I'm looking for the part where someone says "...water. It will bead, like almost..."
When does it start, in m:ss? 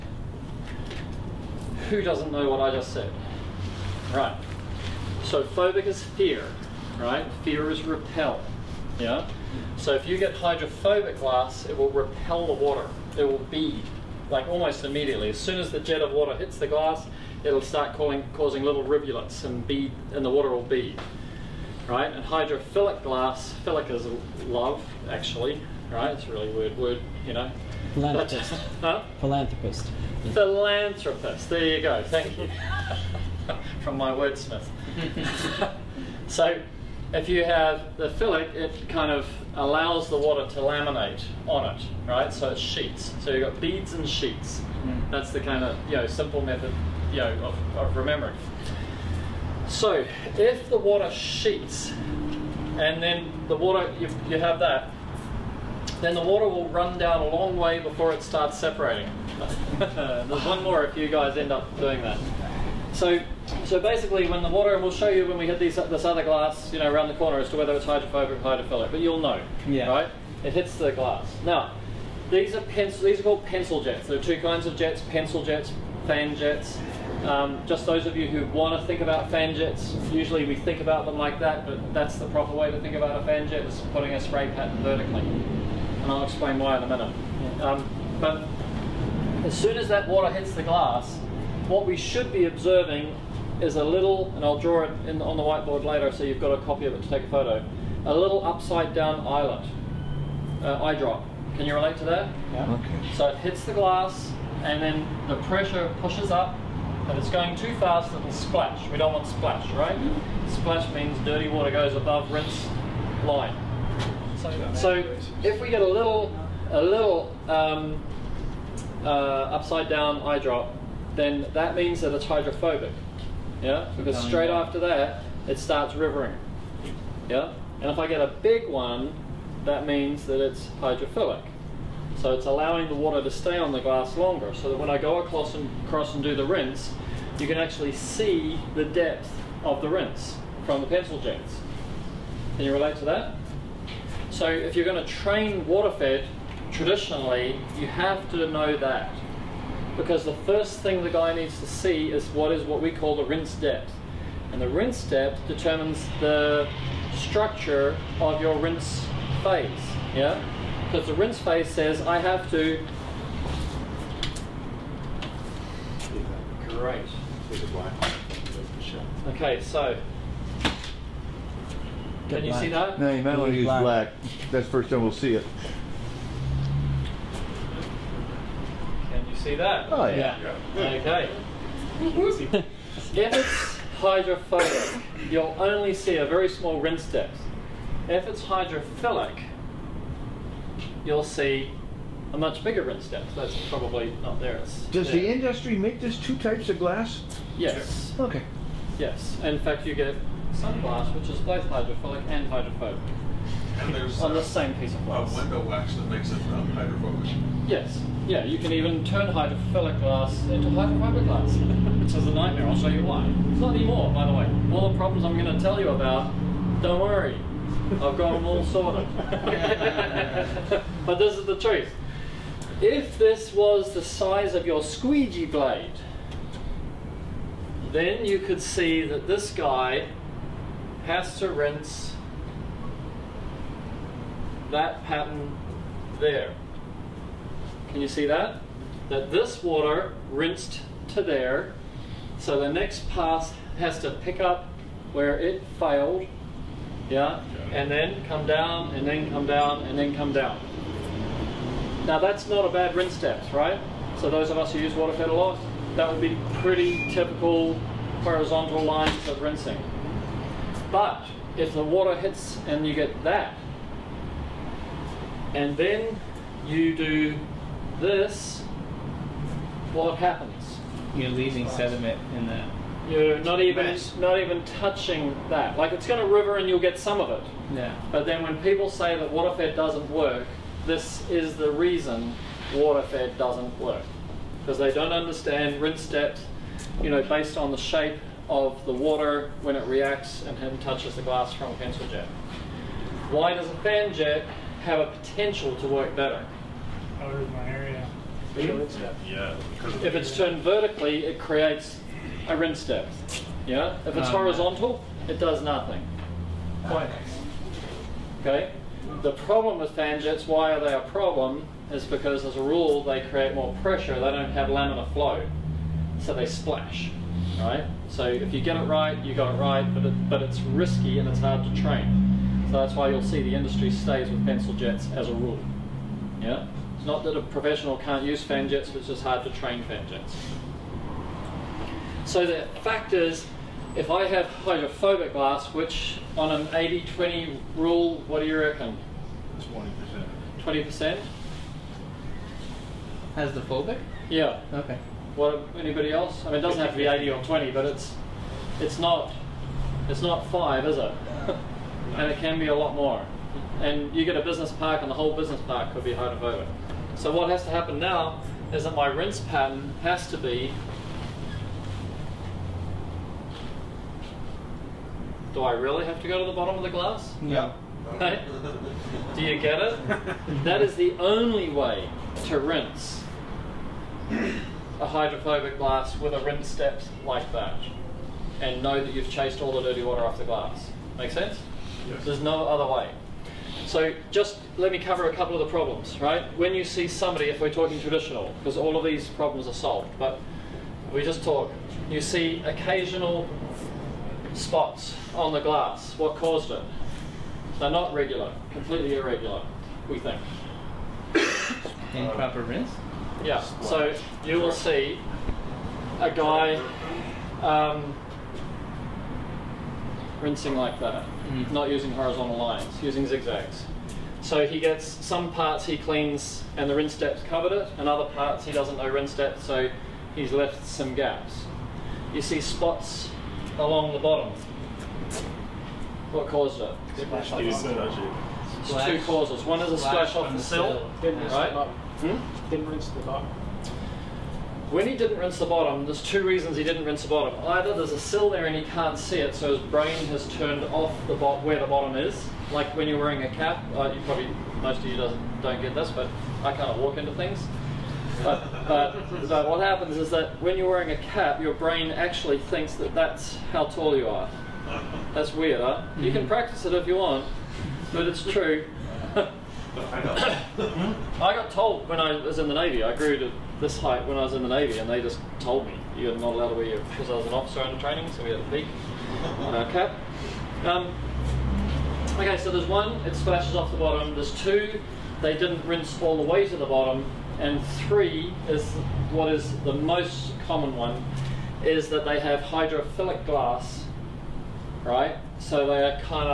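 0:12.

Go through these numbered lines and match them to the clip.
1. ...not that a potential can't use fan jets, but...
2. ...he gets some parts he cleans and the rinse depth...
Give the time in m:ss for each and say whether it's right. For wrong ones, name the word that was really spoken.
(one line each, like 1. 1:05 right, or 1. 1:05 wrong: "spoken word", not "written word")
1. 5:27 wrong: "professional", not "potential"
2. 6:54 right.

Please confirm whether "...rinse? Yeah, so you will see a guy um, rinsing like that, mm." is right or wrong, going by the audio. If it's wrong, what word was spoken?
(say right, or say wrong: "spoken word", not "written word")
right.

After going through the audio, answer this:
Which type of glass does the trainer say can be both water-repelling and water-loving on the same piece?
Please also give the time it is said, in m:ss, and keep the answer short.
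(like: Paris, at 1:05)
Sunglass, at 3:20.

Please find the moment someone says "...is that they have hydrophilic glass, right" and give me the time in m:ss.
8:01.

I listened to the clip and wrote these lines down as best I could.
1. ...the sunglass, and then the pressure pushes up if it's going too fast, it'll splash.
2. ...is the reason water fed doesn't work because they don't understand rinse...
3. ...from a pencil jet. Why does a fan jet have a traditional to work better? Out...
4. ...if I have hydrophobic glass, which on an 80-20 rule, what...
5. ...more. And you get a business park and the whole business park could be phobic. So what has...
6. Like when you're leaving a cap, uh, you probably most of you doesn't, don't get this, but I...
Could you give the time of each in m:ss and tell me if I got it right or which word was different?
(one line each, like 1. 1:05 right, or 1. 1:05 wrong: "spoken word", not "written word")
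1. 1:43 wrong: "glass", not "sunglass"
2. 4:41 right
3. 4:51 wrong: "potential", not "traditional"
4. 5:33 right
5. 5:52 wrong: "hydrophobic", not "phobic"
6. 7:22 wrong: "wearing", not "leaving".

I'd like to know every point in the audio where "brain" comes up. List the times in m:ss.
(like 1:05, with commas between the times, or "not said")
7:19, 7:31.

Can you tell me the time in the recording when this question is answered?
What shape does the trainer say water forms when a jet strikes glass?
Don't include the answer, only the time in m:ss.
1:38.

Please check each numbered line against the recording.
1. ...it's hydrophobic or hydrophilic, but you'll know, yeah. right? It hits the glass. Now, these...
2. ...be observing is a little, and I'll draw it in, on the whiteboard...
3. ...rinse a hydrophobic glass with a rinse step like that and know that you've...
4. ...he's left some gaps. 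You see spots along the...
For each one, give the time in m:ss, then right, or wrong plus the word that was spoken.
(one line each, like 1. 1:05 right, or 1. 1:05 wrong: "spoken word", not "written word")
1. 1:07 right
2. 1:32 right
3. 6:12 right
4. 7:00 right.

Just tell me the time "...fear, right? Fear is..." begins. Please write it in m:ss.
0:06.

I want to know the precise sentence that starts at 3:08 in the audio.
If it's hydrophilic, you'll see a much bigger rinse depth.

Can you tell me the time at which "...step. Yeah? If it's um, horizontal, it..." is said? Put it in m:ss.
5:02.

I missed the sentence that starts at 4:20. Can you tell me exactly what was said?
But if the water hits and you get that, and then you do this, what happens?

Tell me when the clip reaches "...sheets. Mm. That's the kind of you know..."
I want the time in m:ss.
0:44.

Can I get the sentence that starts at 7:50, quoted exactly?
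Um, okay, so there's one, it splashes off the bottom.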